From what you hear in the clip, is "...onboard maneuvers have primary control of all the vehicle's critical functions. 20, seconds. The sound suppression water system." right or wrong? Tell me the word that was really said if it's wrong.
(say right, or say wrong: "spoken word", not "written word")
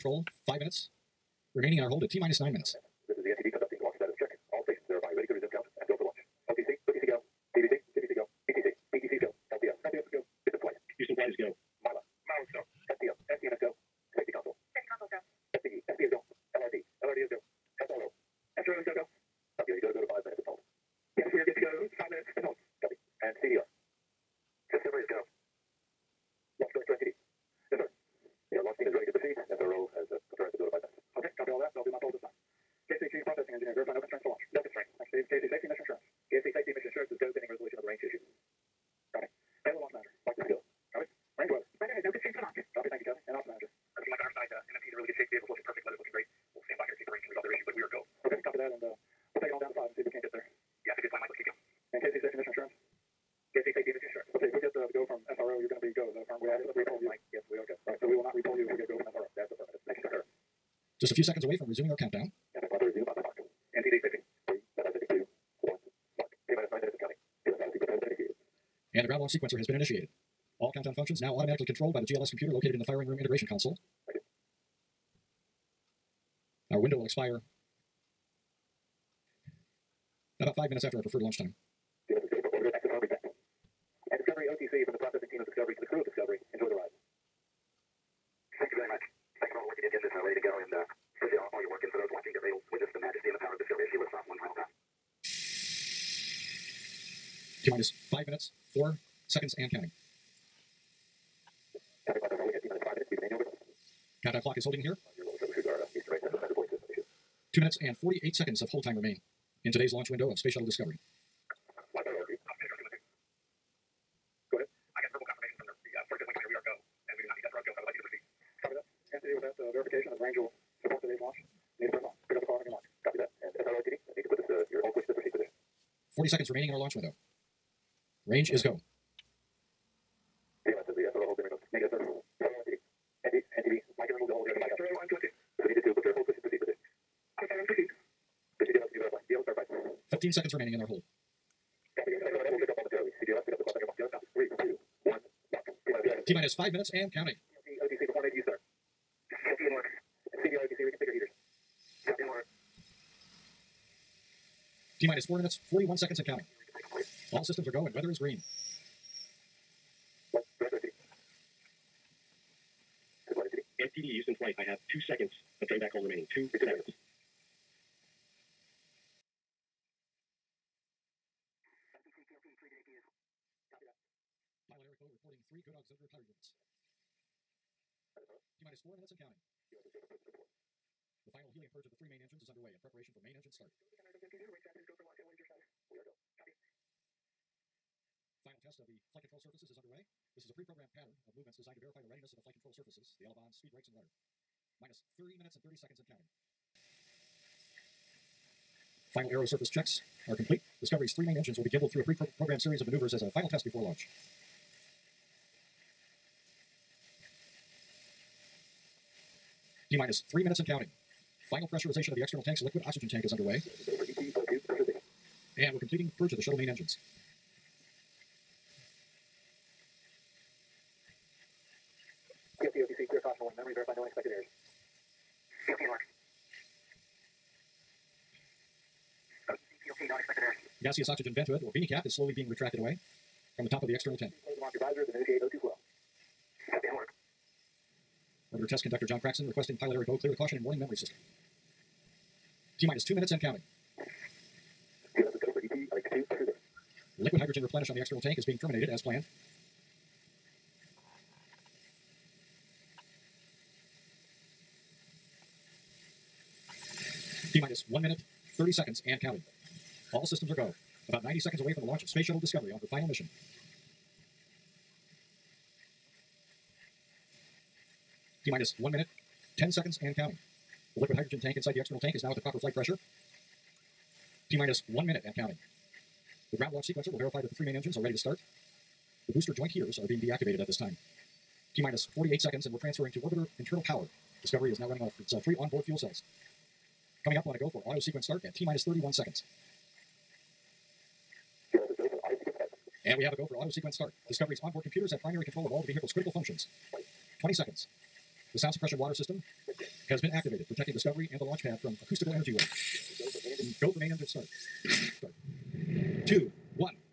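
wrong: "computers", not "maneuvers".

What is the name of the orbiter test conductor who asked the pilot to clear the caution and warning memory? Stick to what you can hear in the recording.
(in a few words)
John Craxton.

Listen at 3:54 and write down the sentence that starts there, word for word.
Close the launcher visors and initiate O2 flow.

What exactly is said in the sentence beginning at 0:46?
We'll stand by here and see if the range can resolve their issue, but we are go.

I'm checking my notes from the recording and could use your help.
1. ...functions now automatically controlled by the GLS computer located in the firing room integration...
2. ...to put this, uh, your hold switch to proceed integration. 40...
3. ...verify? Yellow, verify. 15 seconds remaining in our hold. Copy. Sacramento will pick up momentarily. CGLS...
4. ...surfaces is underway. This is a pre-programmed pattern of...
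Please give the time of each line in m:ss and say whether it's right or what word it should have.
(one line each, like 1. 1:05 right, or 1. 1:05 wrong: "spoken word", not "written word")
1. 1:10 right
2. 2:04 wrong: "position", not "integration"
3. 2:18 right
4. 3:09 right.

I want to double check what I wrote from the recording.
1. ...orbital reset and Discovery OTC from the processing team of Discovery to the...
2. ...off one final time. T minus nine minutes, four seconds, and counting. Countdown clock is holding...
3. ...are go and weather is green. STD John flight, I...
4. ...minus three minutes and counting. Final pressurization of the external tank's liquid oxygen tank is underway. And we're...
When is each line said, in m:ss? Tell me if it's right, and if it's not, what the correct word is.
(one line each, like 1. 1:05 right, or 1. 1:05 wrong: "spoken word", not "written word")
1. 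1:22 right
2. 1:34 wrong: "five", not "nine"
3. 2:37 wrong: "Houston", not "John"
4. 3:29 right.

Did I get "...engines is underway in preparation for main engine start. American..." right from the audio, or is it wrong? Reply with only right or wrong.
right.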